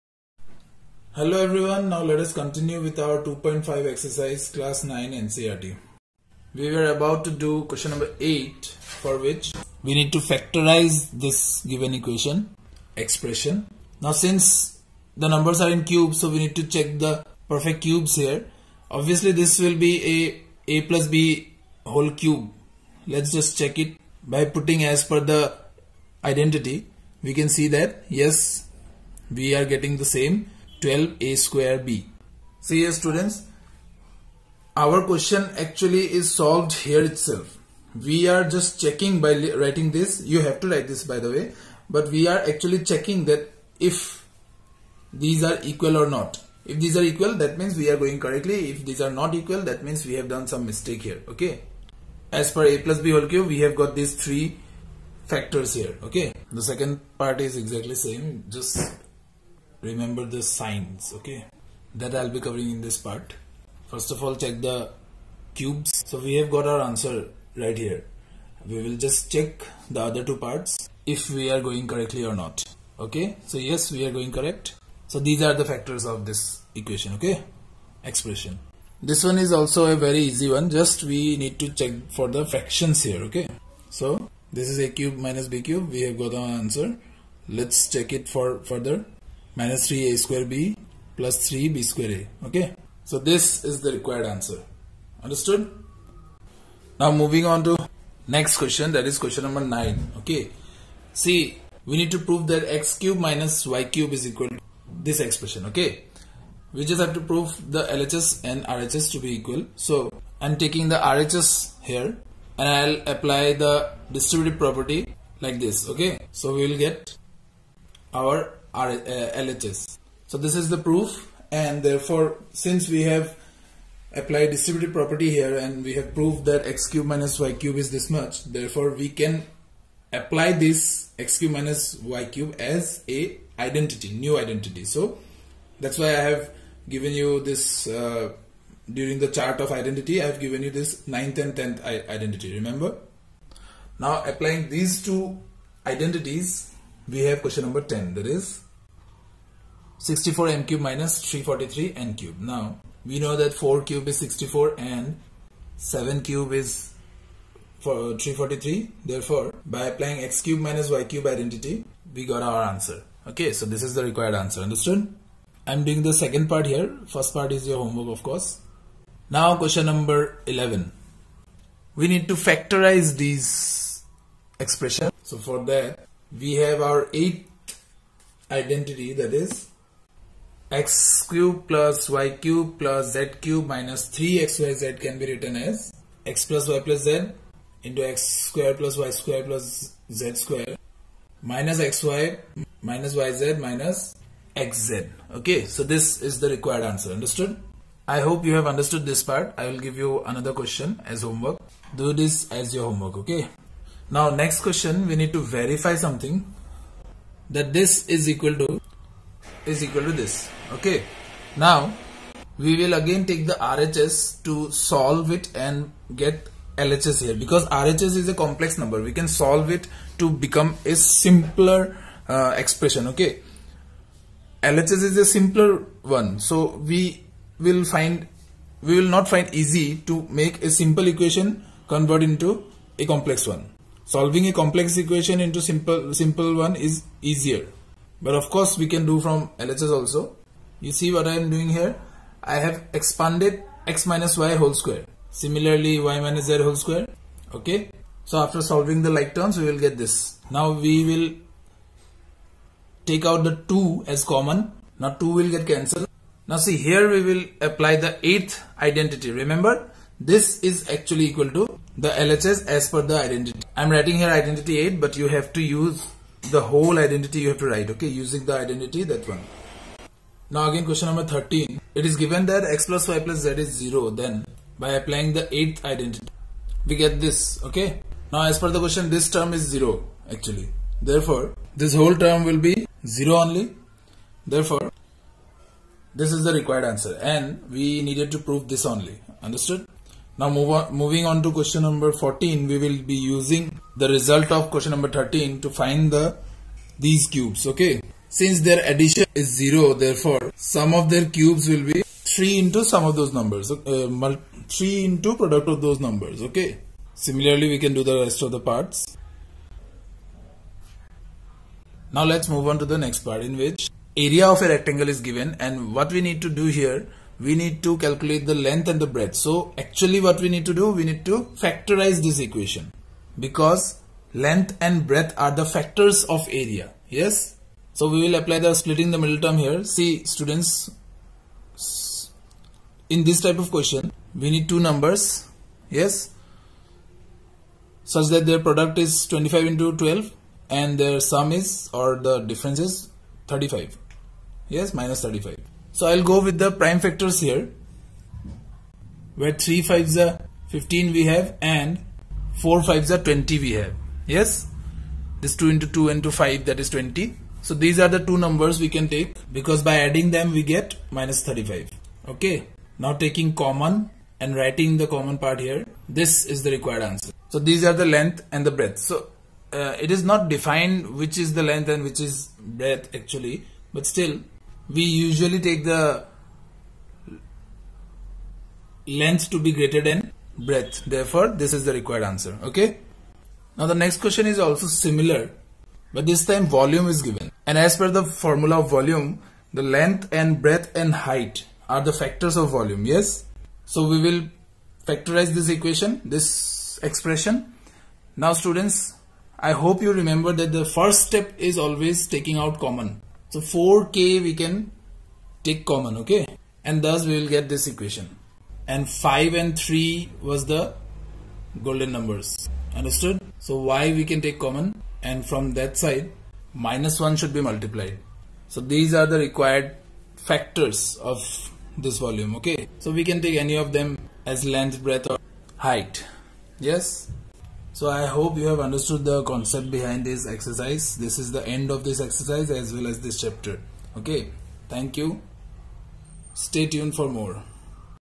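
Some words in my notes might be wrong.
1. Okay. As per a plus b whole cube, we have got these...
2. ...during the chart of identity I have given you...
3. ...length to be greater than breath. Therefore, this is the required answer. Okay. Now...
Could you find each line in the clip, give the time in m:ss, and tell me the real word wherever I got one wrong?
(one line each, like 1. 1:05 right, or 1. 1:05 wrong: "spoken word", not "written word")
1. 0:51 right
2. 2:18 right
3. 6:19 right.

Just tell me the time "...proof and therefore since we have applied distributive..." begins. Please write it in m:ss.
2:00.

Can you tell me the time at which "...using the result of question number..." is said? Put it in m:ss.
4:53.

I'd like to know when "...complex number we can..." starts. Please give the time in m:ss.
3:38.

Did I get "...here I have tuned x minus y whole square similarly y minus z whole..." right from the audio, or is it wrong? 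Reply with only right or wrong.
wrong.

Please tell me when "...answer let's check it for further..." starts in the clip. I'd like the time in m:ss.
1:26.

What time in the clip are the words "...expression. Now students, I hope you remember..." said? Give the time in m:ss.
6:37.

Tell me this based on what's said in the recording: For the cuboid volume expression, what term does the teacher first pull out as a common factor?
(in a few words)
4k.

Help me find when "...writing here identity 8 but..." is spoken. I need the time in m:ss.
4:23.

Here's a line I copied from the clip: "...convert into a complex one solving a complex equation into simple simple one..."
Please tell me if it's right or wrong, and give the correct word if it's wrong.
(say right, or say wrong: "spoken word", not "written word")
right.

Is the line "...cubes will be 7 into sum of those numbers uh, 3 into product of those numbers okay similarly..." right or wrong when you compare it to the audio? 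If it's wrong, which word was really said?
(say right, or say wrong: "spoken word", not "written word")
wrong: "3", not "7".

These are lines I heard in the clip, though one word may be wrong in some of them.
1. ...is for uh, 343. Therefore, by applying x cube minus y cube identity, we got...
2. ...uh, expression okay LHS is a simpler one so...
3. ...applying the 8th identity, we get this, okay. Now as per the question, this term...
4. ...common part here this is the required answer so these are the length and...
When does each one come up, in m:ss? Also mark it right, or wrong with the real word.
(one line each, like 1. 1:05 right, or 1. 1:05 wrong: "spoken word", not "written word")
1. 2:36 right
2. 3:42 right
3. 4:34 right
4. 6:05 right.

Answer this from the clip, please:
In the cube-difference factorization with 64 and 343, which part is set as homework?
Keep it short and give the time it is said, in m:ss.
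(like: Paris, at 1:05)
First part, at 2:47.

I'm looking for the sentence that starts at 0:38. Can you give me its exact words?
We are just checking by writing this.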